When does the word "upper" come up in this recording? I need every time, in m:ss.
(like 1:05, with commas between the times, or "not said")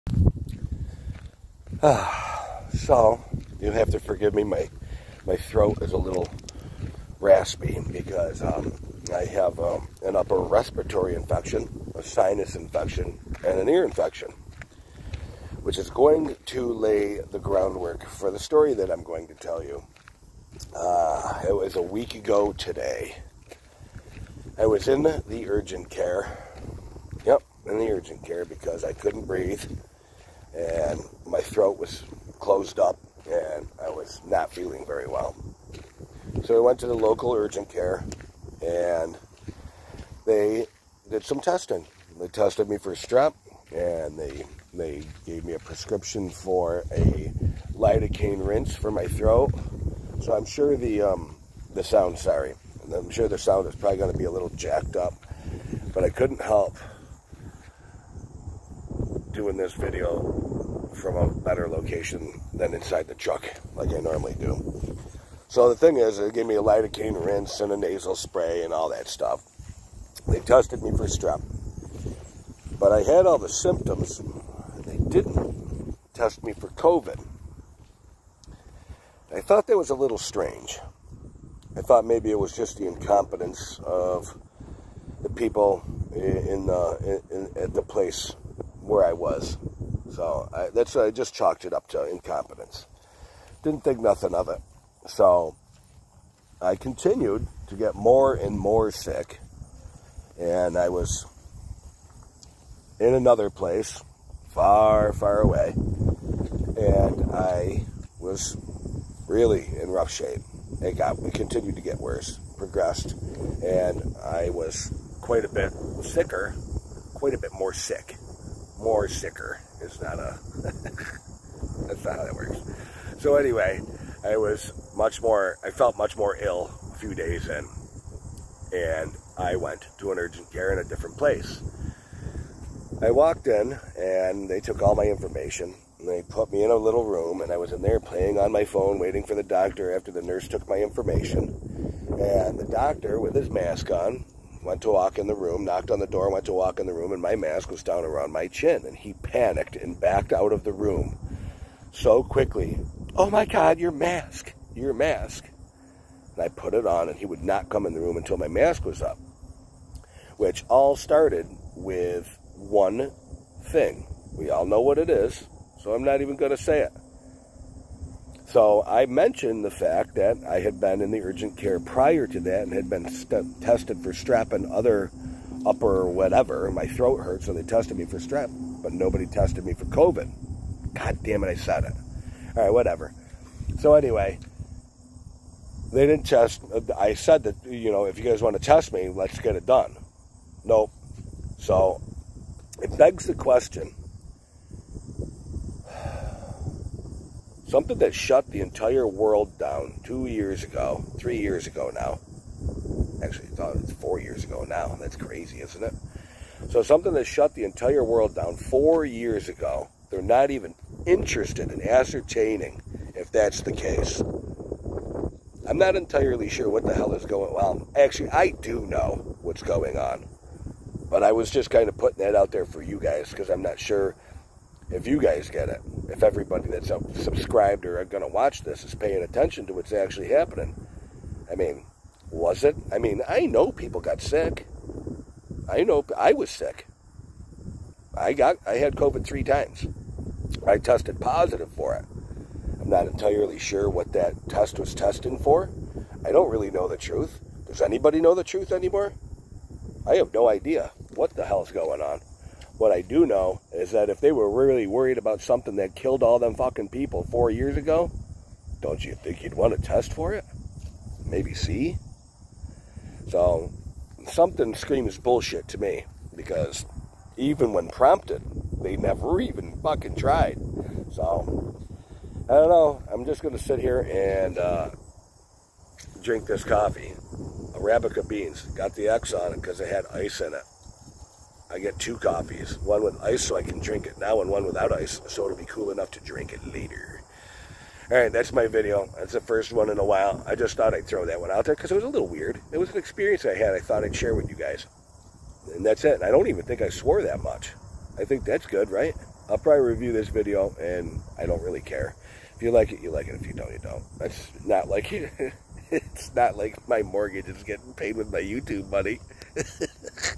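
0:10, 2:55.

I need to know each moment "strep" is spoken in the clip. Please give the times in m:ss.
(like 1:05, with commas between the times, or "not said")
0:42, 1:11, 2:54, 2:58.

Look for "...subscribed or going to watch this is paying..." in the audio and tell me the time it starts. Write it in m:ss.
3:47.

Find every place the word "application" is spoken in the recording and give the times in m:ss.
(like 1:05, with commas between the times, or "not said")
not said.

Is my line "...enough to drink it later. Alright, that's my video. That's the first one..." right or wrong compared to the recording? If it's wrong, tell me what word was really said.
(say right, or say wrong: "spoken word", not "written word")
right.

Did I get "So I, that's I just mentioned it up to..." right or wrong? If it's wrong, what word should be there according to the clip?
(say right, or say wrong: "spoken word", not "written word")
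wrong: "chalked", not "mentioned".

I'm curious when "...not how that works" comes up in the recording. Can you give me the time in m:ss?
2:02.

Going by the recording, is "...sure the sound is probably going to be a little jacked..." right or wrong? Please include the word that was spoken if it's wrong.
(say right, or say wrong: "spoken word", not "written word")
right.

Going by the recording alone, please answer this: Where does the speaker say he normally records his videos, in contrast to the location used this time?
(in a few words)
Inside the truck.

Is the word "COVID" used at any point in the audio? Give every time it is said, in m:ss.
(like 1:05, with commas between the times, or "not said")
1:16, 2:59, 3:58.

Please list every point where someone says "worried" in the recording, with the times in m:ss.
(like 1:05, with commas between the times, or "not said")
4:14.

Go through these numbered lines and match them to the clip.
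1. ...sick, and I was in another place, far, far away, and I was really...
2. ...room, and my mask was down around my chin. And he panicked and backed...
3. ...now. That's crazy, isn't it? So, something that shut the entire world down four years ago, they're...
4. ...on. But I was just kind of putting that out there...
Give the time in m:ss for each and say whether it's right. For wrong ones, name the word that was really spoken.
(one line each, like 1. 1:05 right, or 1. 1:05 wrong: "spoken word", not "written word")
1. 1:38 right
2. 2:26 right
3. 3:24 right
4. 3:39 right.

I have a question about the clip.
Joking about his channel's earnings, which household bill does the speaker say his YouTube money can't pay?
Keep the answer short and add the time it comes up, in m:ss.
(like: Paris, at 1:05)
Mortgage, at 5:07.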